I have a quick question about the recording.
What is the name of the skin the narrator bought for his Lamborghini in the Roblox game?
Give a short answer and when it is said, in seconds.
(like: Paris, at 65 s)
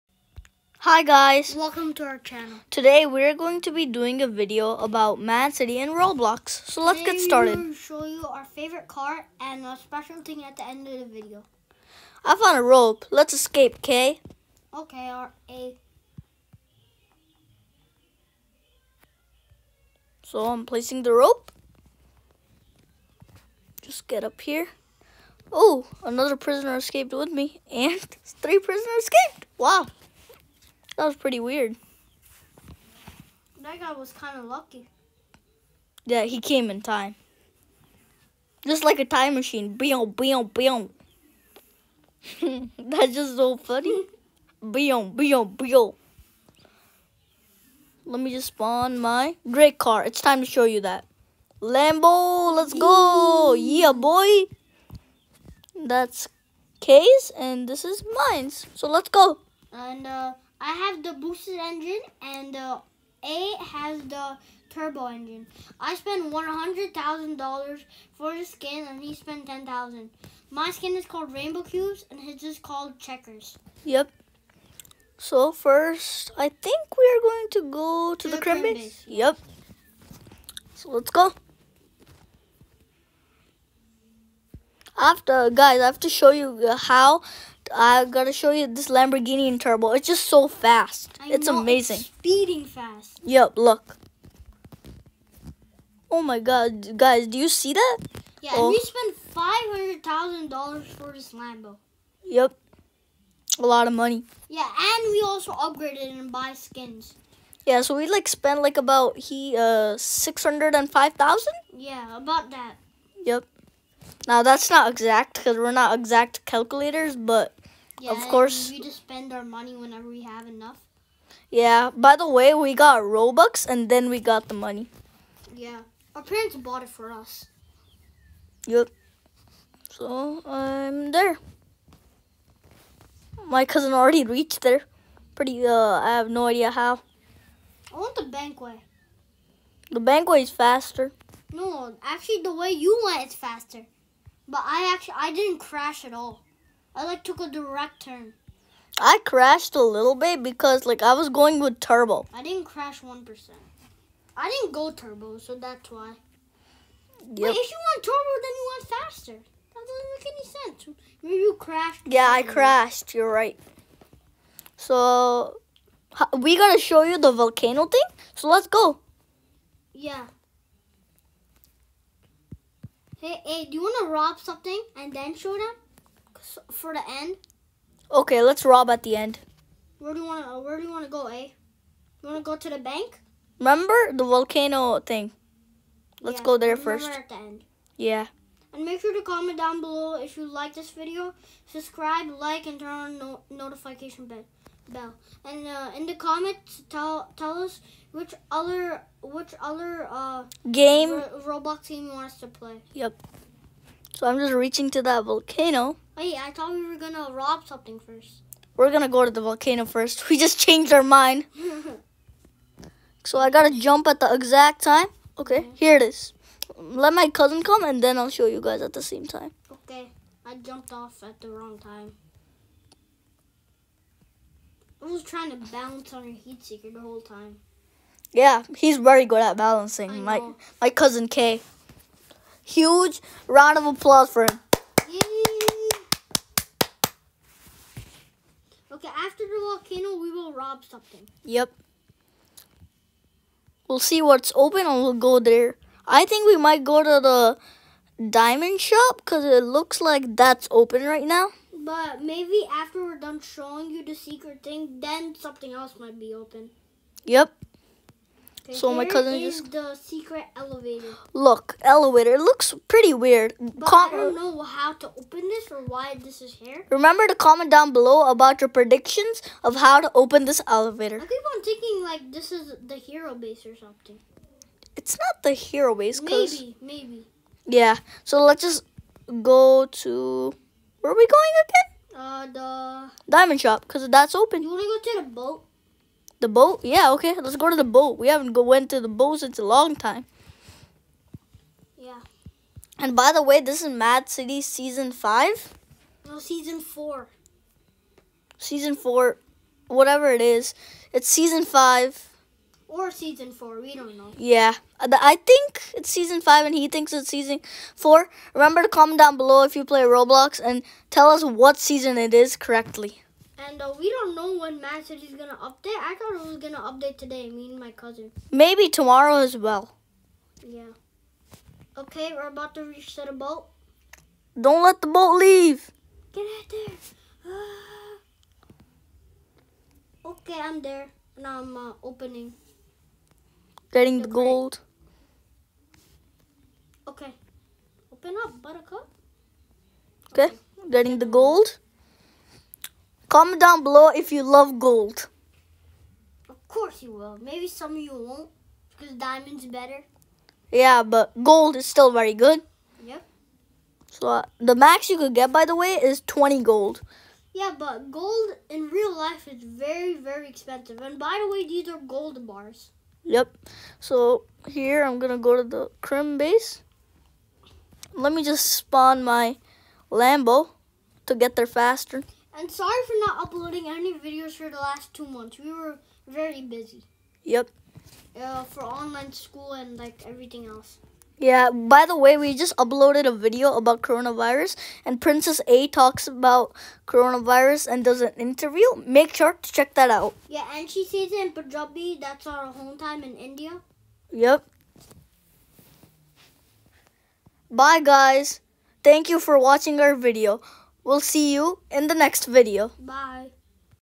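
Rainbow Cubes, at 71 s.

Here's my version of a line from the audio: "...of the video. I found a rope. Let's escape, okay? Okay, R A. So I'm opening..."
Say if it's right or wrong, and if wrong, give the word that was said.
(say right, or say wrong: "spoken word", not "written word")
wrong: "placing", not "opening".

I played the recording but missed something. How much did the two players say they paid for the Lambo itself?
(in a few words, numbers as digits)
$500,000.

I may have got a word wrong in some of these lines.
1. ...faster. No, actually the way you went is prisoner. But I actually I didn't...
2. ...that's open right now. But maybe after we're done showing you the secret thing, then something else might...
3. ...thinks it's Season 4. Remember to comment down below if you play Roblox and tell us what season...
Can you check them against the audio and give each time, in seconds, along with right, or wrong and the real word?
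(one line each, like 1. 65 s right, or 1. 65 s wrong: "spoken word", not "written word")
1. 140 s wrong: "faster", not "prisoner"
2. 250 s right
3. 306 s right.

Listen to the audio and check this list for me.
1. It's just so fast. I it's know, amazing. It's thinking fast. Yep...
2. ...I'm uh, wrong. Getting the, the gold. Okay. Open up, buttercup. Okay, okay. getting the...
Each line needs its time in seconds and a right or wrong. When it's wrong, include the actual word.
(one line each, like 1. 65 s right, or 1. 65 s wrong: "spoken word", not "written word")
1. 89 s wrong: "speeding", not "thinking"
2. 331 s wrong: "opening", not "wrong".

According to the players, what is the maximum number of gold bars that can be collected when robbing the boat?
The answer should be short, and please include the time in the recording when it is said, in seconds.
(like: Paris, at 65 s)
20, at 356 s.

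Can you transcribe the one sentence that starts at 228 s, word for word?
Yeah, he's very good at balancing.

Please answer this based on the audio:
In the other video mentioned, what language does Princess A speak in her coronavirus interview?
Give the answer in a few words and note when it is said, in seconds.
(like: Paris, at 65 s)
Punjabi, at 391 s.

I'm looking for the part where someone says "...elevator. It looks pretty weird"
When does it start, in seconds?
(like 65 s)
261 s.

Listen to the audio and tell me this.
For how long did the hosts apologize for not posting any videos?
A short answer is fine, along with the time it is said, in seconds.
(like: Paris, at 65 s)
two months, at 375 s.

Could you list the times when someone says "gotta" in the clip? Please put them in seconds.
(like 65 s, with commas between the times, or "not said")
166 s, 213 s.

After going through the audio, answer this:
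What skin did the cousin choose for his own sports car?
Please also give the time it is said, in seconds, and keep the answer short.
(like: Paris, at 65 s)
Checkers, at 72 s.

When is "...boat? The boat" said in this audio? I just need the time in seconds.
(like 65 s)
285 s.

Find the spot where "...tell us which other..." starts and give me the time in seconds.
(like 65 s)
197 s.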